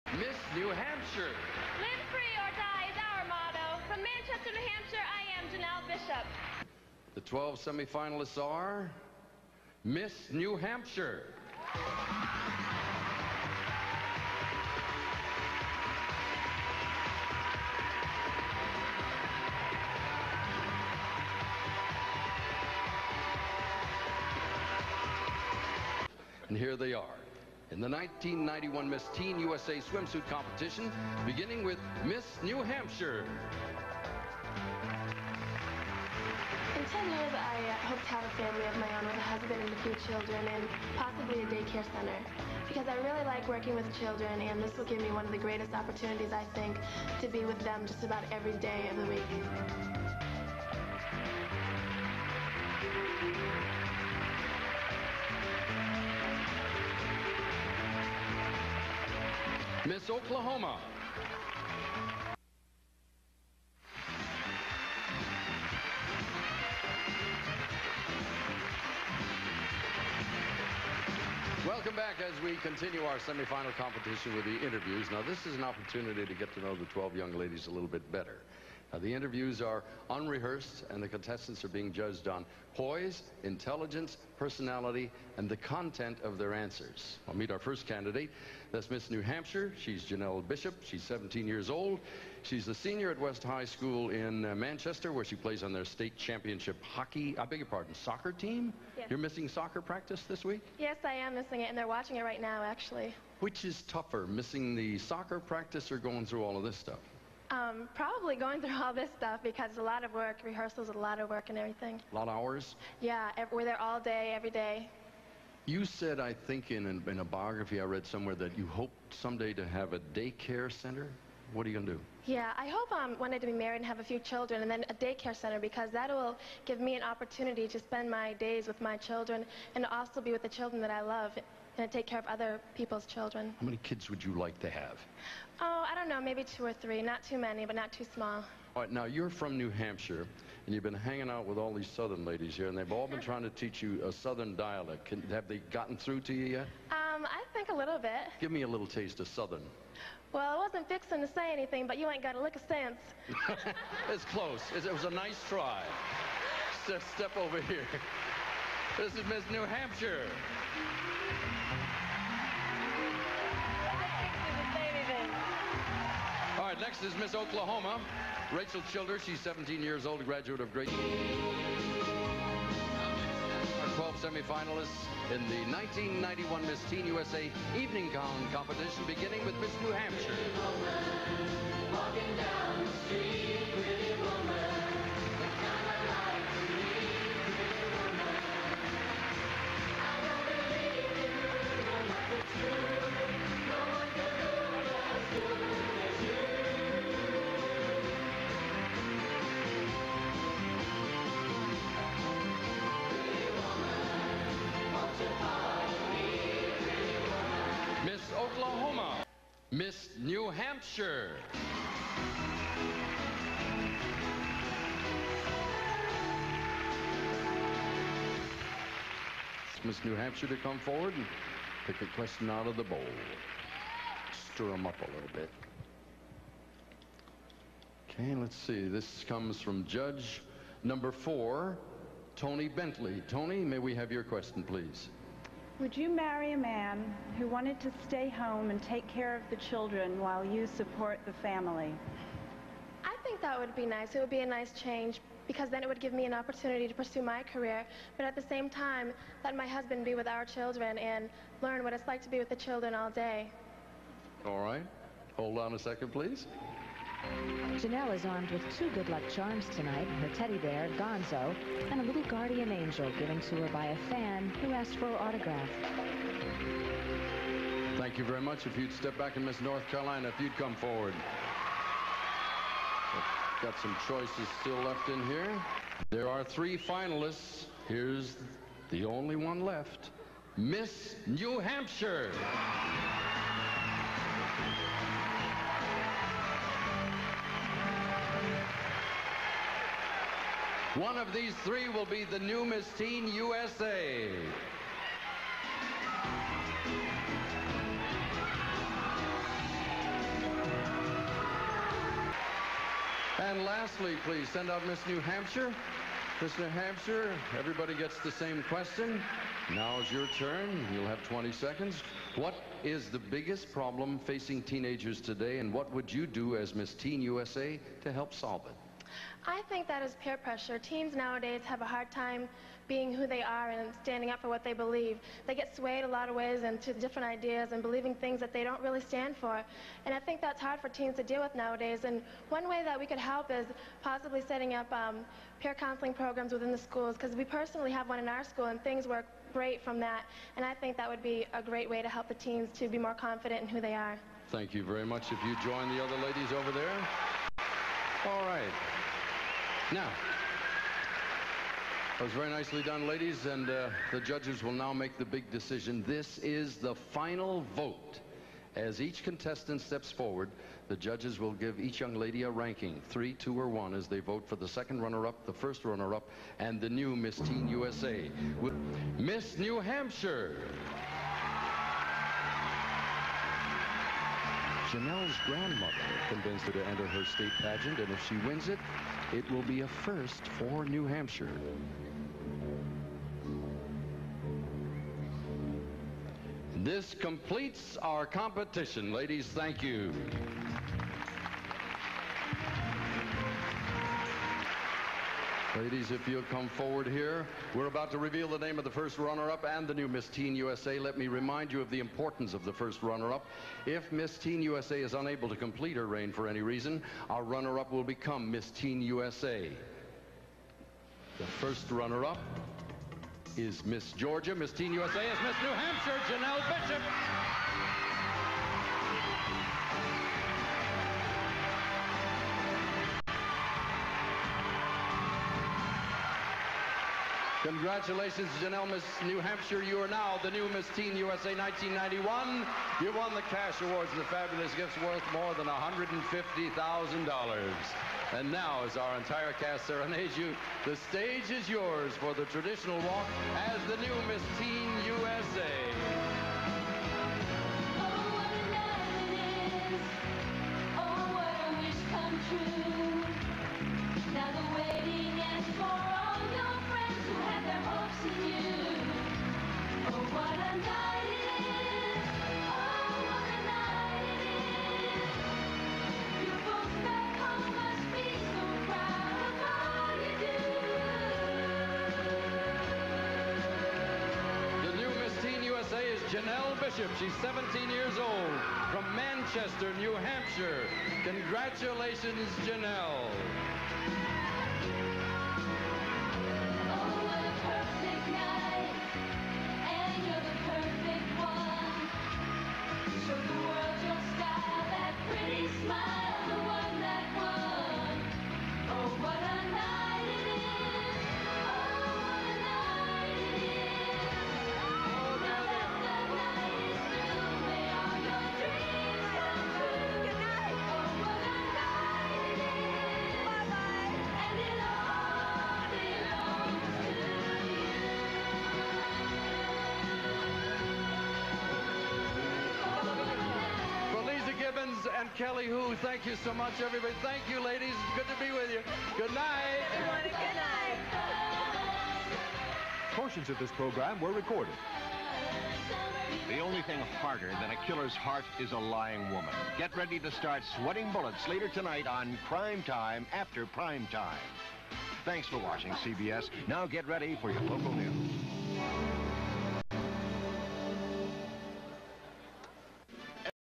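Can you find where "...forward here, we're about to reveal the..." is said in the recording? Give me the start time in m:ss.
6:36.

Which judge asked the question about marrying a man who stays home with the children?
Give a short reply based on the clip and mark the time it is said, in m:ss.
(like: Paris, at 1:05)
Tony Bentley, at 3:52.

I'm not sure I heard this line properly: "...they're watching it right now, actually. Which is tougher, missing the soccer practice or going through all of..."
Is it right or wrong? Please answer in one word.
right.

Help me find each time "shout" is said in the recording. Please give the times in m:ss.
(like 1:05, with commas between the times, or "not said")
not said.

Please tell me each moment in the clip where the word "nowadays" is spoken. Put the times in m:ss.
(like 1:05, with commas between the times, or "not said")
5:21, 5:31.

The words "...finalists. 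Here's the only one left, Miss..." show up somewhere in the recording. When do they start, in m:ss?
4:36.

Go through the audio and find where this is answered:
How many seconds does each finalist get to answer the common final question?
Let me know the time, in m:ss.
5:11.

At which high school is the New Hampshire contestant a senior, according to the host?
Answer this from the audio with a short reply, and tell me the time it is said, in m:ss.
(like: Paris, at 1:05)
West High School, at 1:33.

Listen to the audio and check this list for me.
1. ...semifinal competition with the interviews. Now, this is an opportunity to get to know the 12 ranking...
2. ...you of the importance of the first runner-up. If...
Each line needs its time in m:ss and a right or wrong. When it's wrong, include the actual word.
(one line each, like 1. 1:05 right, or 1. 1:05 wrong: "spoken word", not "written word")
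1. 1:13 wrong: "young", not "ranking"
2. 6:41 right.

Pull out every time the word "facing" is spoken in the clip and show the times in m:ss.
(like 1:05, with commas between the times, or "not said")
5:14.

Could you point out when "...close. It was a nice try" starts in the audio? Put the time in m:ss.
2:34.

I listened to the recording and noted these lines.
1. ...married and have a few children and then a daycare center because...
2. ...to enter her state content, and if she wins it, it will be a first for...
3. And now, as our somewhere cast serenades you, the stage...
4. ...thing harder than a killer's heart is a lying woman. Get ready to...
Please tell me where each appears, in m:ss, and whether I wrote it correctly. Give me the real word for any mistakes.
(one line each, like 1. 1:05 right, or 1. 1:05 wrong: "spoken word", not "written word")
1. 2:03 right
2. 6:16 wrong: "pageant", not "content"
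3. 7:18 wrong: "entire", not "somewhere"
4. 8:56 right.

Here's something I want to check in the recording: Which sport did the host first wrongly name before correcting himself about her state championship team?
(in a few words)
Hockey.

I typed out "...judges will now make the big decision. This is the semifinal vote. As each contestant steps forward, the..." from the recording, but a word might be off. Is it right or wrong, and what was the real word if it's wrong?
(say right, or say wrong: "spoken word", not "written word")
wrong: "final", not "semifinal".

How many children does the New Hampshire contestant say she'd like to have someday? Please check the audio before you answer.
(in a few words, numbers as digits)
Two or three.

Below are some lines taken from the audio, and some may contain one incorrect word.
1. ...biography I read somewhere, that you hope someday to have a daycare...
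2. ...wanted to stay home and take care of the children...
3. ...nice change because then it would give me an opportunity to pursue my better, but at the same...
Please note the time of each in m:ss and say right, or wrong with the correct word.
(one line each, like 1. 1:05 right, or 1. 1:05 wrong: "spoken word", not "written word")
1. 1:57 right
2. 3:57 right
3. 4:04 wrong: "career", not "better".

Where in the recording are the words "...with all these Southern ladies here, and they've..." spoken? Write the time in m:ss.
2:21.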